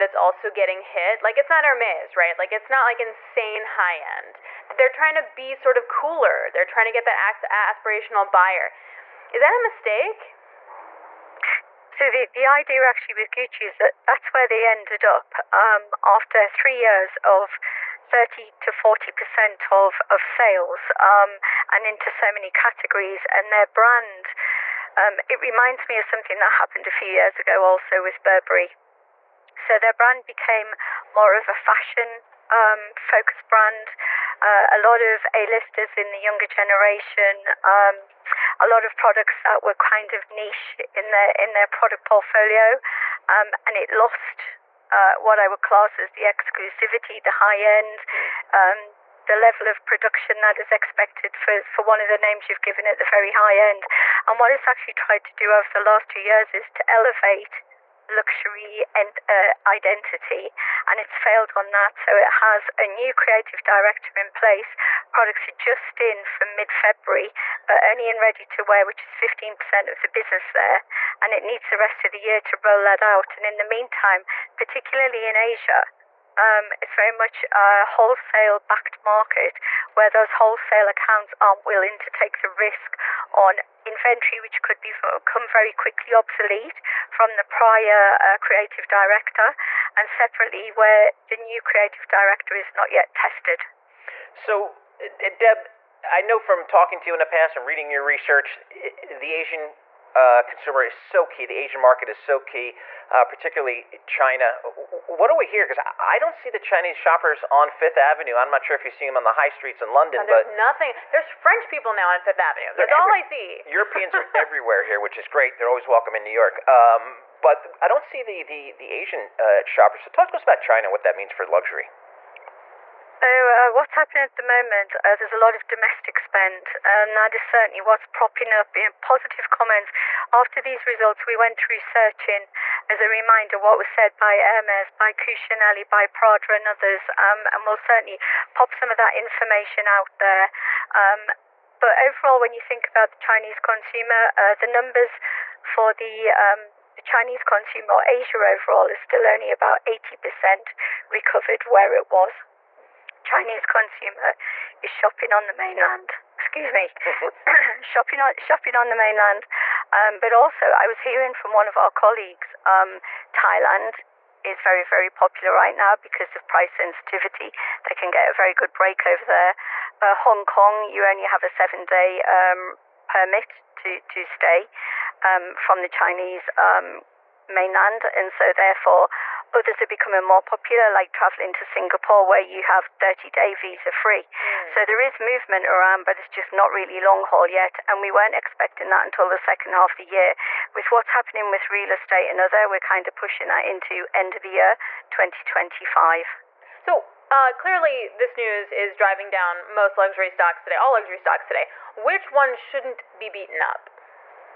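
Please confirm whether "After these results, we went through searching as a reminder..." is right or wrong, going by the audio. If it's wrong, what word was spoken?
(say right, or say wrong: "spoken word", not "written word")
right.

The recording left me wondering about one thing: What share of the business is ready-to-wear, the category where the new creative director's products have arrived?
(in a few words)
15%.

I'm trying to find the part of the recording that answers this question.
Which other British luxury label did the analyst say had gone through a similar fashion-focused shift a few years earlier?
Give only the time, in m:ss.
0:28.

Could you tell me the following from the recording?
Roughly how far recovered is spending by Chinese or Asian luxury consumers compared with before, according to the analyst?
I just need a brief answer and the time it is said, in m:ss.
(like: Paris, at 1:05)
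80%, at 2:29.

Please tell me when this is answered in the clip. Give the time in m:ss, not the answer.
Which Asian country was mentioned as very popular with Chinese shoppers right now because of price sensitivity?
2:43.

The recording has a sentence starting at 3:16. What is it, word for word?
So, uh, clearly, this news is driving down most luxury stocks today, all luxury stocks today.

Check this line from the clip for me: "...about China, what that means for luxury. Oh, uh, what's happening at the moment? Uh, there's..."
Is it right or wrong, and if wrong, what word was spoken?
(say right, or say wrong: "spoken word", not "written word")
right.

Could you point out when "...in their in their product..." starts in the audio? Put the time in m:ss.
0:40.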